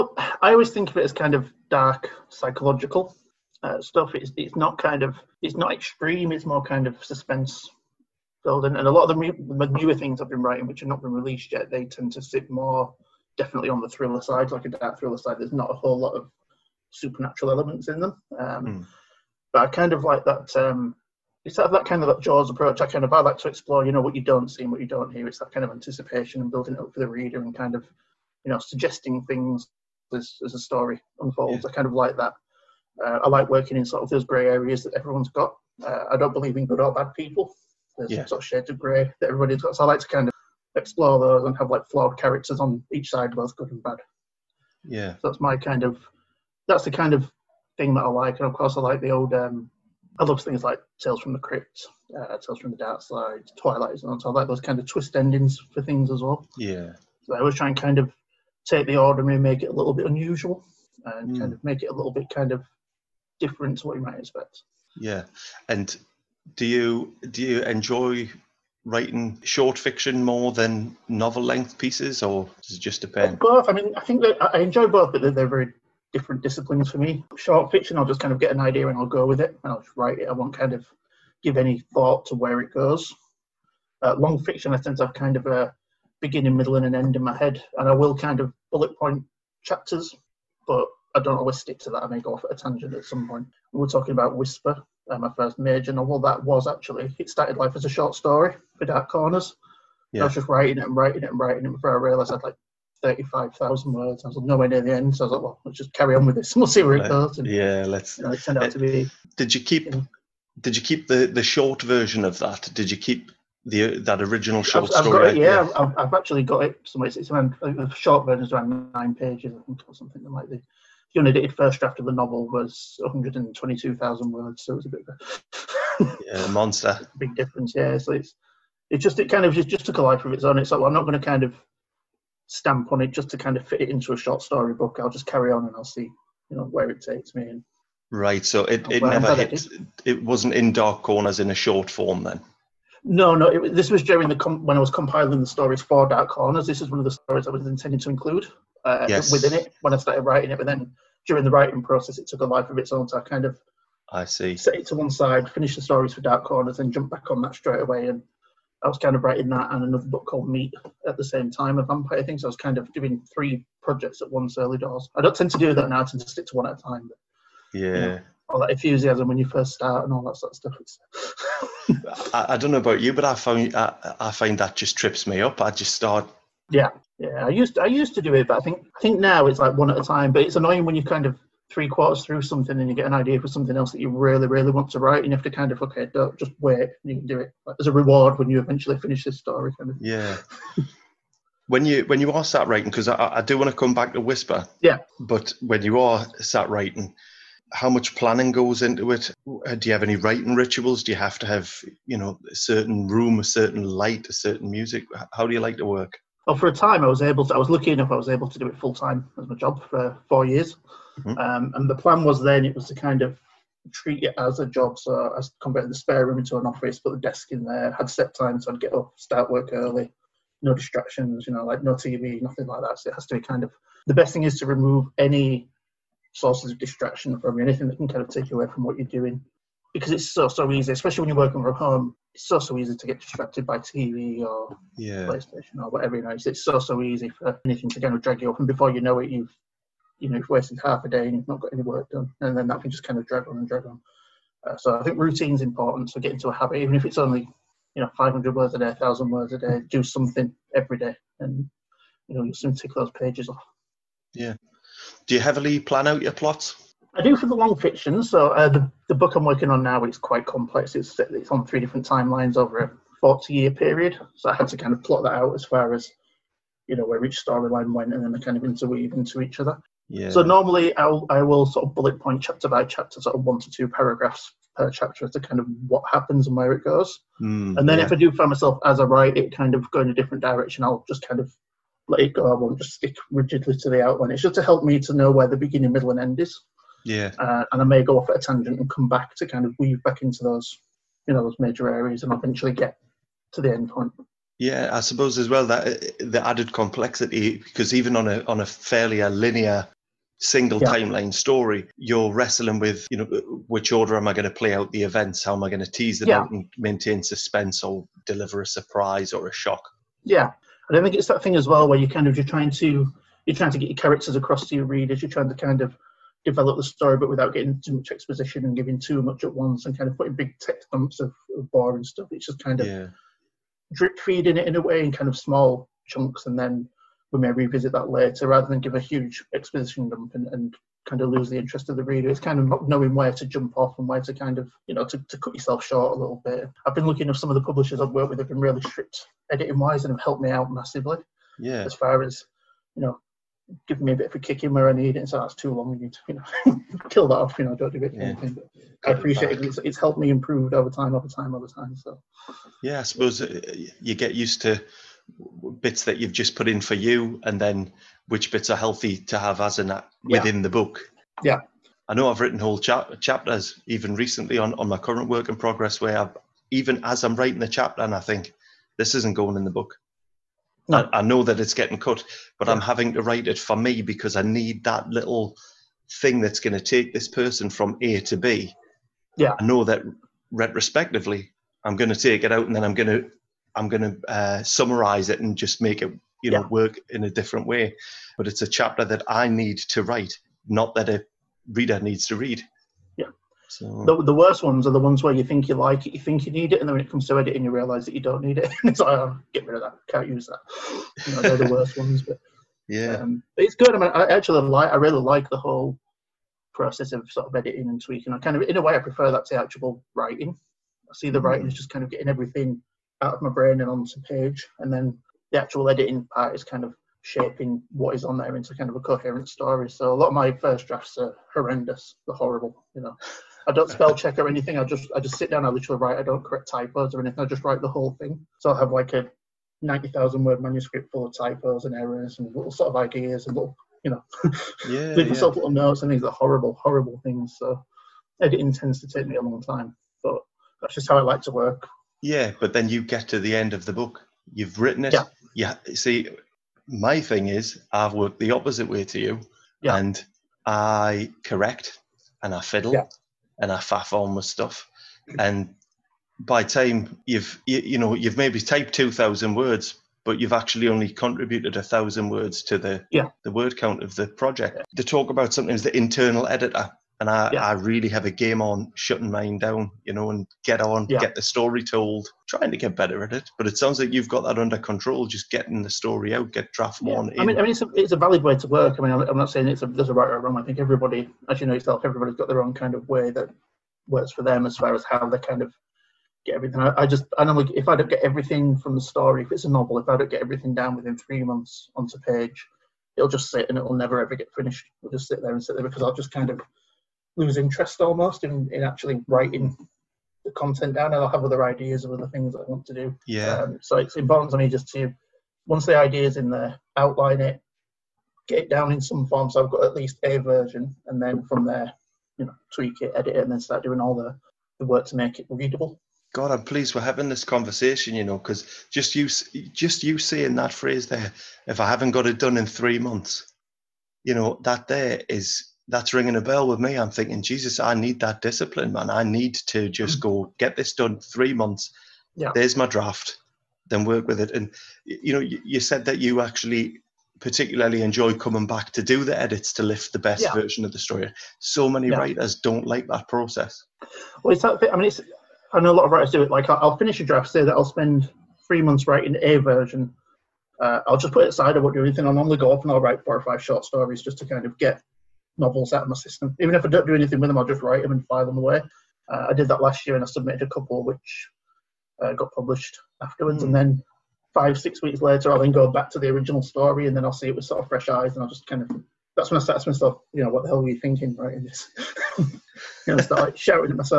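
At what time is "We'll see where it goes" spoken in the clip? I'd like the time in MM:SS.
01:46.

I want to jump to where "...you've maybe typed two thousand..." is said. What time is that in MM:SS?
07:38.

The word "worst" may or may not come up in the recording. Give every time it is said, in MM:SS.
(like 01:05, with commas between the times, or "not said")
06:34, 06:41.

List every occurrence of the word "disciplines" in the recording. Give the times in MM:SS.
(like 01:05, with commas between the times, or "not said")
01:16, 08:48.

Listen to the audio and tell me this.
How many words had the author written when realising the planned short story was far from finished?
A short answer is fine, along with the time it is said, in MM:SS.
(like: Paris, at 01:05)
35000, at 01:43.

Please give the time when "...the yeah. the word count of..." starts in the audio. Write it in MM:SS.
07:42.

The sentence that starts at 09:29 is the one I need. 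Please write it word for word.
That's when I start to myself, you know, what the hell were you thinking, right?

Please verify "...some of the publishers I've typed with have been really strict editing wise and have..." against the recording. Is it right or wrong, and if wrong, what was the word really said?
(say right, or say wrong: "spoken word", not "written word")
wrong: "worked", not "typed".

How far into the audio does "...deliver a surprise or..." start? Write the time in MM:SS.
05:08.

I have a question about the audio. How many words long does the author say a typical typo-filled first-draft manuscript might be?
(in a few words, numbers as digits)
90000.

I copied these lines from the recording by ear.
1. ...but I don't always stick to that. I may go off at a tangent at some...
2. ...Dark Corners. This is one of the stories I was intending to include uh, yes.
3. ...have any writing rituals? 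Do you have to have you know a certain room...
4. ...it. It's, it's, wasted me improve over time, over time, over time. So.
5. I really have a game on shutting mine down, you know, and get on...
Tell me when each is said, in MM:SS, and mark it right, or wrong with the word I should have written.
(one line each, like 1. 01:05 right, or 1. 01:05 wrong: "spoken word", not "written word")
1. 01:30 right
2. 02:26 right
3. 03:19 right
4. 05:49 wrong: "helped", not "wasted"
5. 07:47 right.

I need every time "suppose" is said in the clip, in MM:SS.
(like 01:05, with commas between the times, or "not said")
04:55, 05:53.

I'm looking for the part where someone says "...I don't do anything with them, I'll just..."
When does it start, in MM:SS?
09:16.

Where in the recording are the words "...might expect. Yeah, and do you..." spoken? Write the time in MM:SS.
01:04.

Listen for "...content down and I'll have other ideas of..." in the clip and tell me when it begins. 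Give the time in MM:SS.
08:20.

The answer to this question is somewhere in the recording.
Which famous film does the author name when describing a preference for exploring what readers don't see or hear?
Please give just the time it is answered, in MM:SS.
00:22.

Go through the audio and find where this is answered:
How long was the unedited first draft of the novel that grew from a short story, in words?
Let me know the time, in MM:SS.
02:02.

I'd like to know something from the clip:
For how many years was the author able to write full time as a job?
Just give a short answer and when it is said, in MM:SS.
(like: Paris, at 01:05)
4, at 03:30.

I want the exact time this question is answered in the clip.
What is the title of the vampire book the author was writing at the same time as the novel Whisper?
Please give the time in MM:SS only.
02:40.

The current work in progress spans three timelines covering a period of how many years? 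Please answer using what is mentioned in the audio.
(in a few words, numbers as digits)
40.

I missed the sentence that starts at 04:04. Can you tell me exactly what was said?
Uh, so I think routine's important.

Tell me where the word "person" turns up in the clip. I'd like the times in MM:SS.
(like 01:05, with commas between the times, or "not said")
06:17.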